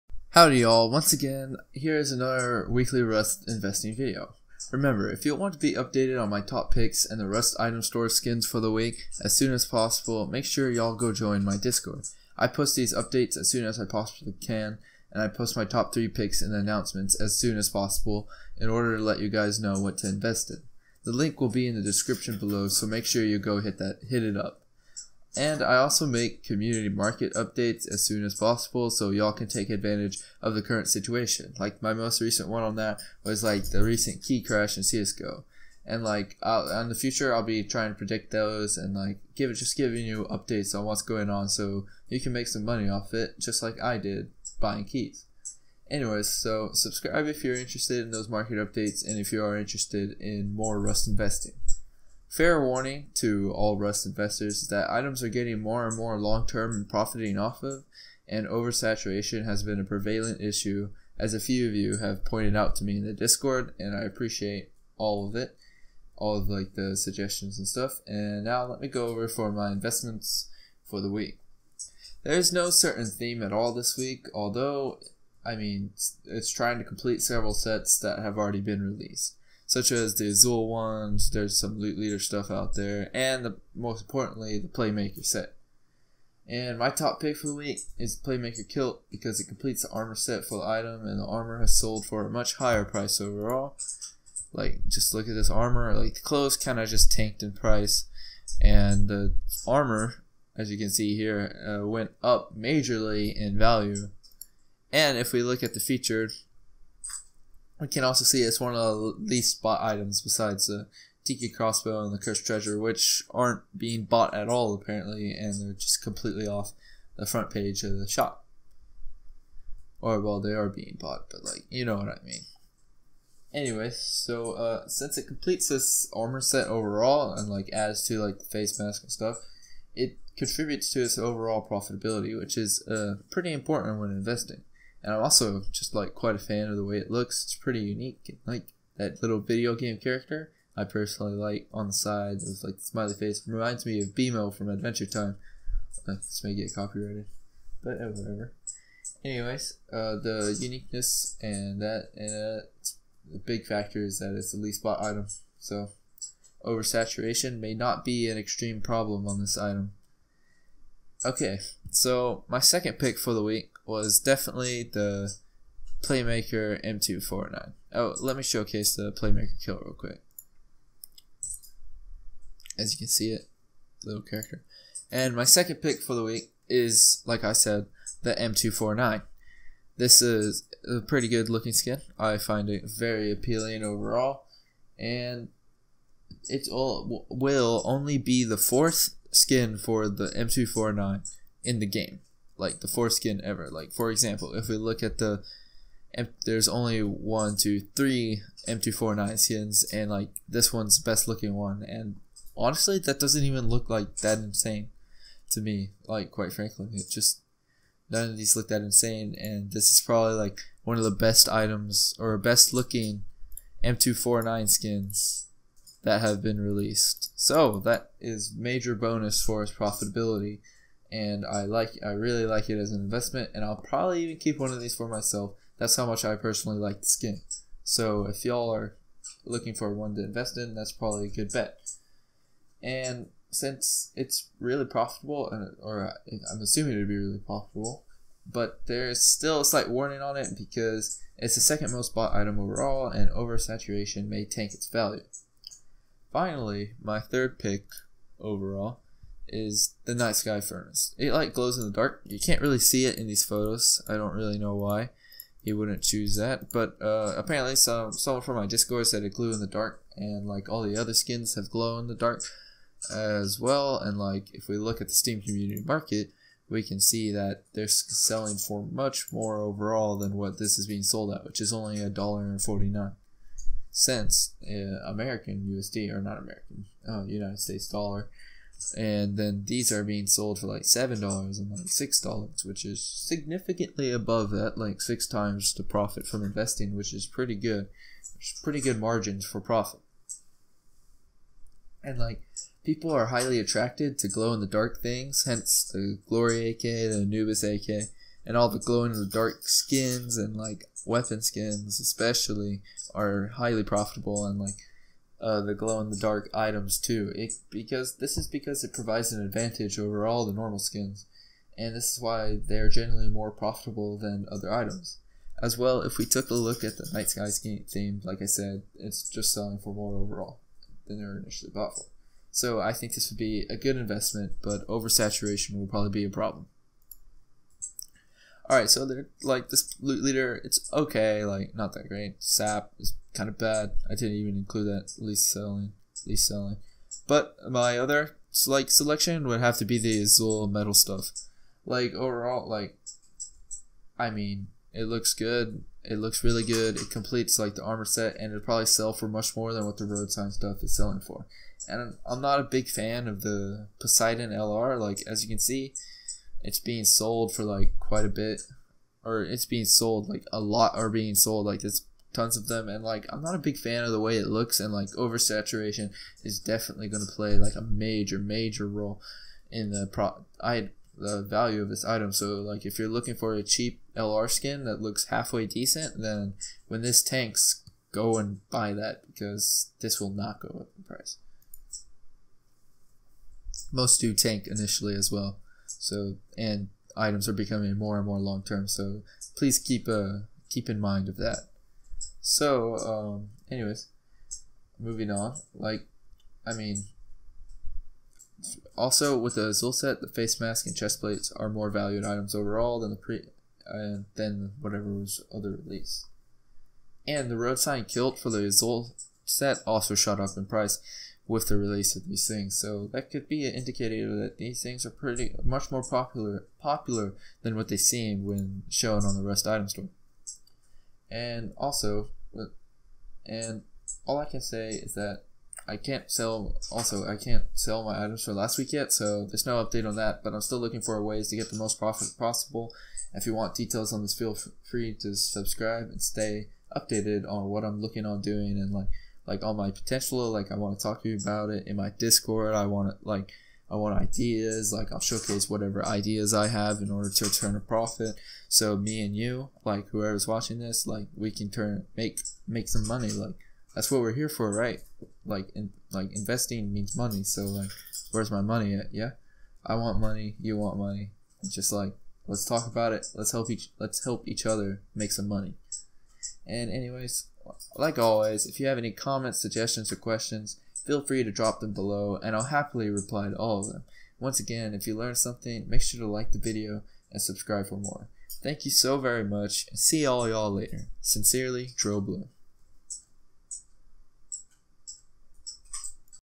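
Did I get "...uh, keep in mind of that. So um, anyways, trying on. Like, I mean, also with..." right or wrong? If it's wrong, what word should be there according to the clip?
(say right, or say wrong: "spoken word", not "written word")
wrong: "moving", not "trying".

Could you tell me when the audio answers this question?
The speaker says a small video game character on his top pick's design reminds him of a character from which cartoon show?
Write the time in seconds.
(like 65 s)
144 s.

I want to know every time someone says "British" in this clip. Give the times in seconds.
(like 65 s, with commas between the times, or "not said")
not said.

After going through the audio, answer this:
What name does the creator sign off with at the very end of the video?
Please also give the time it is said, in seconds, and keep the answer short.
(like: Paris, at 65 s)
DroBlue, at 481 s.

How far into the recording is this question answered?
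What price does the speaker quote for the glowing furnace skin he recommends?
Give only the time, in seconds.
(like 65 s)
272 s.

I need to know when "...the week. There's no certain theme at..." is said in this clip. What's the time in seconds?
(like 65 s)
71 s.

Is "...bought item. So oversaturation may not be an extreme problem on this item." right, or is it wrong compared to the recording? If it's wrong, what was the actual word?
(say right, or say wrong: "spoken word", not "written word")
right.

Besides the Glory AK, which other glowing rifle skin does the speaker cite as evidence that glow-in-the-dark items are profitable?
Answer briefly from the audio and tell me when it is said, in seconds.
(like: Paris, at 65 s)
Anubis AK, at 297 s.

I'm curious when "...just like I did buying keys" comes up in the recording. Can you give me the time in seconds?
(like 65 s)
43 s.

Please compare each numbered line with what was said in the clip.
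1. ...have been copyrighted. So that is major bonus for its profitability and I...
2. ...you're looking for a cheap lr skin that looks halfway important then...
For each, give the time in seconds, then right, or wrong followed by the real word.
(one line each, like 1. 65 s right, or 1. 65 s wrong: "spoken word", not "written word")
1. 216 s wrong: "released", not "copyrighted"
2. 372 s wrong: "decent", not "important".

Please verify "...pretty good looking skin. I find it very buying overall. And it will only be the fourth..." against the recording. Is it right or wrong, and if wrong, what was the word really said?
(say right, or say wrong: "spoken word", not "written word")
wrong: "appealing", not "buying".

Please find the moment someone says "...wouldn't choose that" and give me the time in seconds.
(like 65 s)
255 s.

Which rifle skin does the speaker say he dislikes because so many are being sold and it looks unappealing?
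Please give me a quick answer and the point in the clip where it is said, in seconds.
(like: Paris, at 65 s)
Poseidon LR, at 353 s.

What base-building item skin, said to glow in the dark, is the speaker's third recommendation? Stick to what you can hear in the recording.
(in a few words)
night sky furnace.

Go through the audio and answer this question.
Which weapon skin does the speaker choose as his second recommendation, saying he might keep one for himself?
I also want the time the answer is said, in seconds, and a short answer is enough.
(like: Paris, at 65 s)
Playmaker M249, at 166 s.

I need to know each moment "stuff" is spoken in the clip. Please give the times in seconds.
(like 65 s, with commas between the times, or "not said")
67 s, 82 s, 129 s, 340 s, 350 s.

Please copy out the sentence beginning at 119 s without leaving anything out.
Or, well, they are being bought, but, like, you know what I mean.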